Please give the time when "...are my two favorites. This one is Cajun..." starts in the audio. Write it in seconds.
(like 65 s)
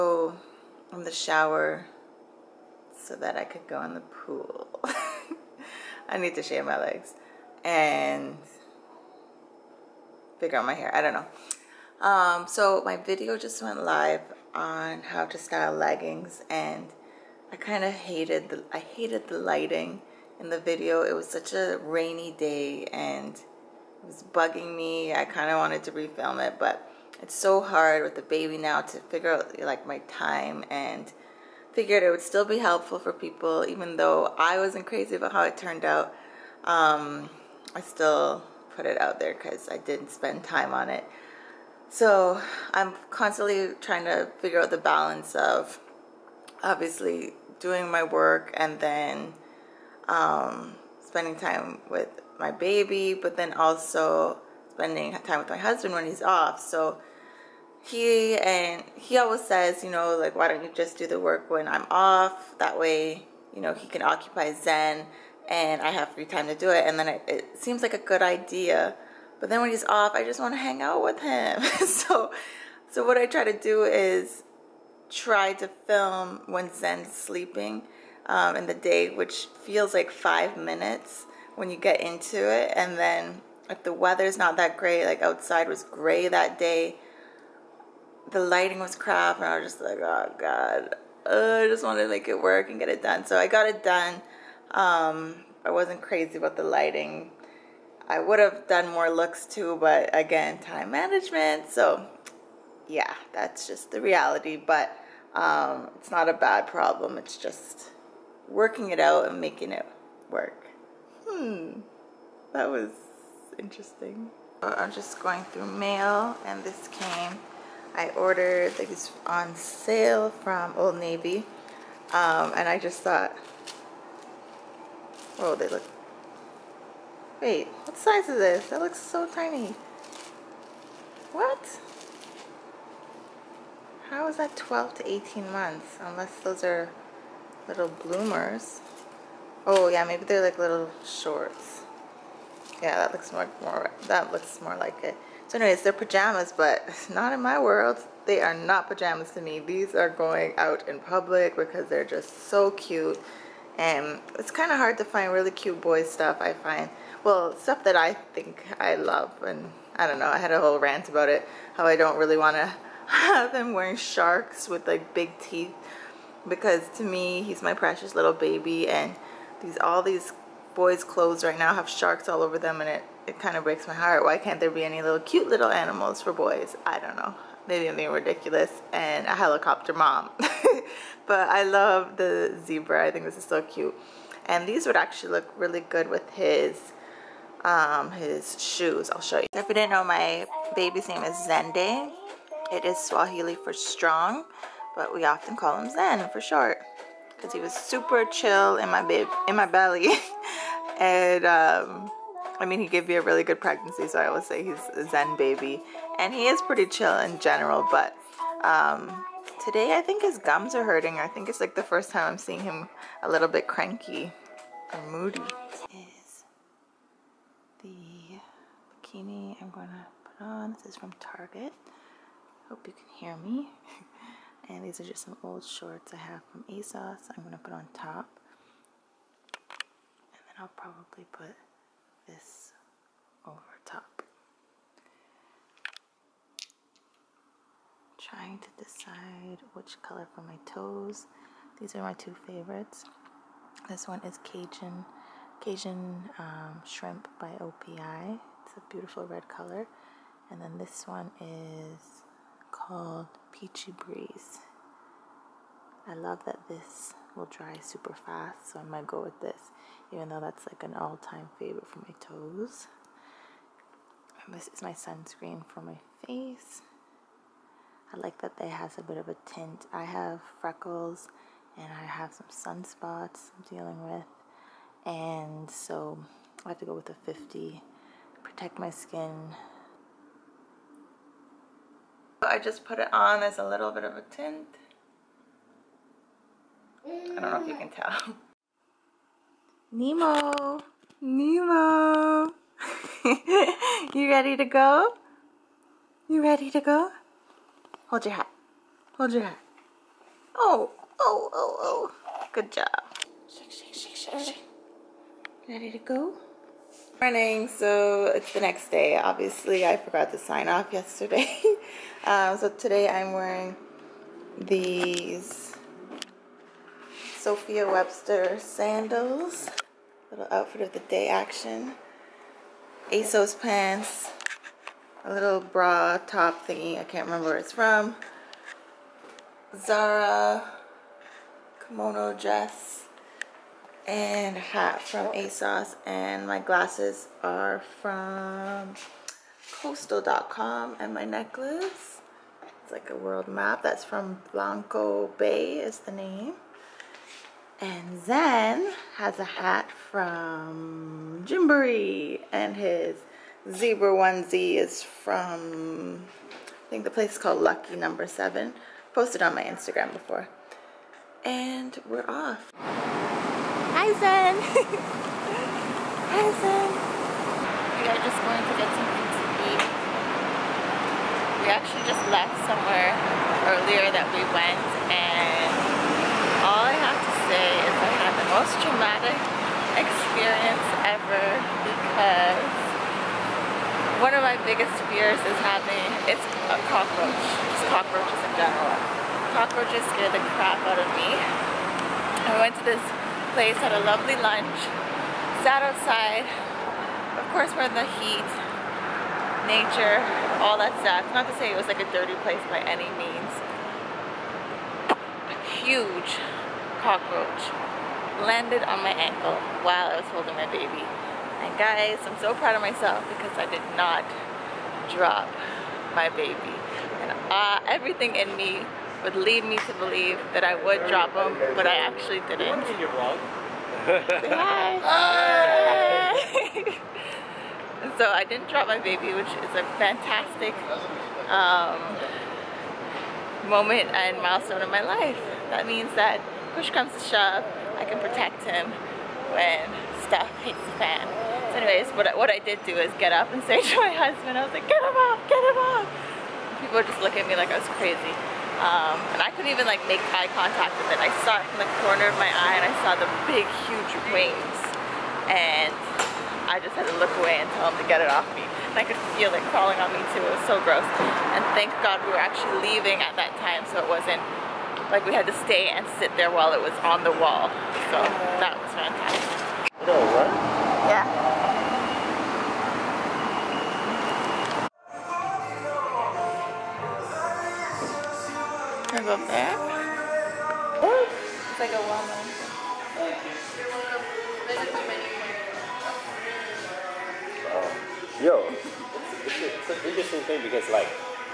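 241 s.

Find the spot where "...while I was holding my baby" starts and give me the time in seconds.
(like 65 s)
409 s.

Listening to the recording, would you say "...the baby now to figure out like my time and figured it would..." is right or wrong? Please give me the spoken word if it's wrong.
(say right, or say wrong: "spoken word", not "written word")
right.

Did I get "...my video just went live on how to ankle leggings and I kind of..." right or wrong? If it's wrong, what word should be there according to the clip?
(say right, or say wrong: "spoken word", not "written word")
wrong: "style", not "ankle".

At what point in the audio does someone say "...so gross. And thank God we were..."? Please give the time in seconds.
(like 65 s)
460 s.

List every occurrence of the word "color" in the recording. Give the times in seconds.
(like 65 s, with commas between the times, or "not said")
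240 s, 249 s.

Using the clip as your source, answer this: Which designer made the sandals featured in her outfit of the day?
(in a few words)
Sophia Webster.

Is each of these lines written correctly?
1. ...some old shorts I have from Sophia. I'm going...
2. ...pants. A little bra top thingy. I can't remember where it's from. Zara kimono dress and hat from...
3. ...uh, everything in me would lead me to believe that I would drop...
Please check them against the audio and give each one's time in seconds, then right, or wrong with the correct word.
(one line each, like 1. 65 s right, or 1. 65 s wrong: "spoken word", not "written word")
1. 225 s wrong: "ASOS", not "Sophia"
2. 323 s right
3. 417 s right.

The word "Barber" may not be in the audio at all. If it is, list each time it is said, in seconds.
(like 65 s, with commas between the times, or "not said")
not said.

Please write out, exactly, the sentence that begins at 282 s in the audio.
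I just put it on as a little bit of a tint.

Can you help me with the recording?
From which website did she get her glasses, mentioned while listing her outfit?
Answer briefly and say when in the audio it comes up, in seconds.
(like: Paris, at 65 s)
coastal.com, at 339 s.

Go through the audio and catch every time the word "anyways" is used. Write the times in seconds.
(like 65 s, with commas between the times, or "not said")
145 s, 441 s.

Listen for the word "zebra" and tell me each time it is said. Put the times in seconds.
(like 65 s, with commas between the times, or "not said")
182 s, 353 s.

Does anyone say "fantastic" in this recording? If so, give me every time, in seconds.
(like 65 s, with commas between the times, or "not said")
430 s, 468 s.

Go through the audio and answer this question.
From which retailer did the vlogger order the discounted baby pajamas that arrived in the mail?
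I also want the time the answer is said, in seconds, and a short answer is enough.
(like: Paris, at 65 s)
Old Navy, at 120 s.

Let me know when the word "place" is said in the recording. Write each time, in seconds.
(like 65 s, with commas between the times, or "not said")
357 s, 393 s, 402 s.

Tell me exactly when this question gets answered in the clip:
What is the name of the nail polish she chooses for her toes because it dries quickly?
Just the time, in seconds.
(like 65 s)
253 s.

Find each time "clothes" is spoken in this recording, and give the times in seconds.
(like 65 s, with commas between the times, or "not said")
171 s.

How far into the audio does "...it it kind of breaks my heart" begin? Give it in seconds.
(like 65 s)
172 s.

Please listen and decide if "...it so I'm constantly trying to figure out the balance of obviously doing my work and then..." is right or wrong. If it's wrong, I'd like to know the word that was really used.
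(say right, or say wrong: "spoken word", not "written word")
right.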